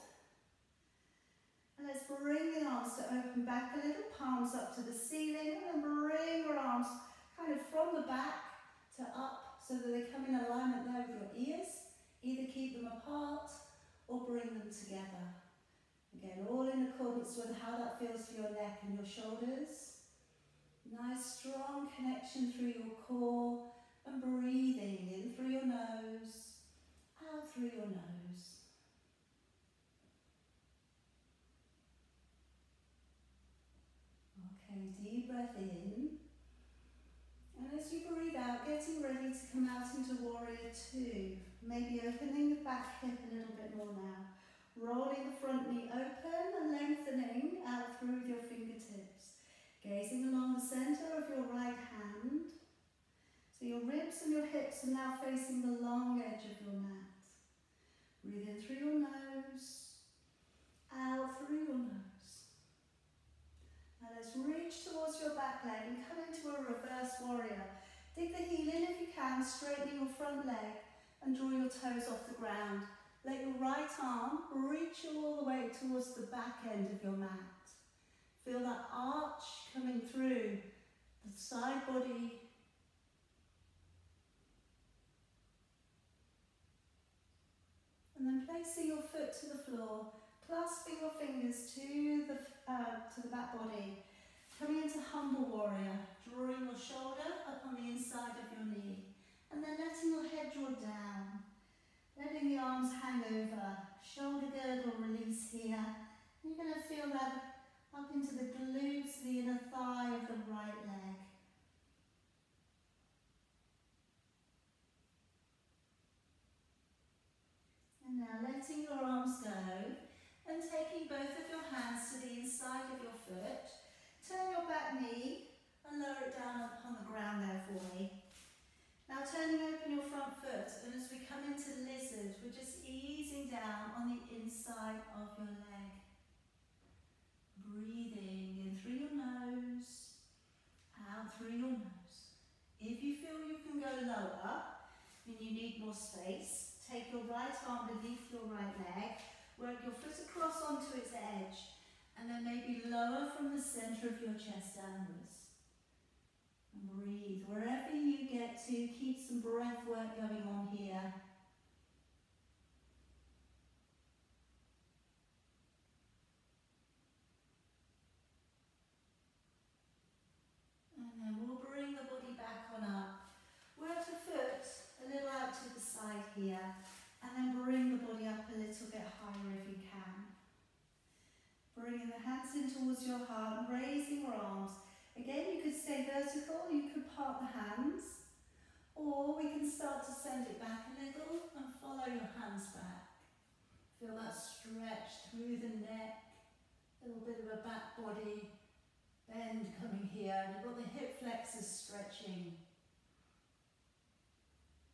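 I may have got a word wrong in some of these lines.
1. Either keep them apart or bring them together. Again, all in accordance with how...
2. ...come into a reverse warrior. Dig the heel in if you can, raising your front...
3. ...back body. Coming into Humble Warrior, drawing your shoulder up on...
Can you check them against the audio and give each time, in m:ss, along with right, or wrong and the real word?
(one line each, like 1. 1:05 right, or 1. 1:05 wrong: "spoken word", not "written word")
1. 0:12 right
2. 1:06 wrong: "straightening", not "raising"
3. 1:33 right.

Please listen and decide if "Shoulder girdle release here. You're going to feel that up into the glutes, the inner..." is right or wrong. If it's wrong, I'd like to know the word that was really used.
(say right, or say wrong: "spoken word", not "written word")
right.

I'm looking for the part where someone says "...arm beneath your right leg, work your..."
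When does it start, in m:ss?
2:27.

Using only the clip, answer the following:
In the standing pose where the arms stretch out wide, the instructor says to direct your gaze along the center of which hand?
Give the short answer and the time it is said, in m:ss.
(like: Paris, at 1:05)
right hand, at 0:51.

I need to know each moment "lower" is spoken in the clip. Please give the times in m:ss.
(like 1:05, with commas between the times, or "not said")
2:05, 2:24, 2:32.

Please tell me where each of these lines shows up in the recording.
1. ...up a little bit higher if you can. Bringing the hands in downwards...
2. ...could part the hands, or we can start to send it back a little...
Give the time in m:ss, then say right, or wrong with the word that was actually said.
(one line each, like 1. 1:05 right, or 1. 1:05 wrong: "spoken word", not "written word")
1. 2:58 wrong: "towards", not "downwards"
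2. 3:06 right.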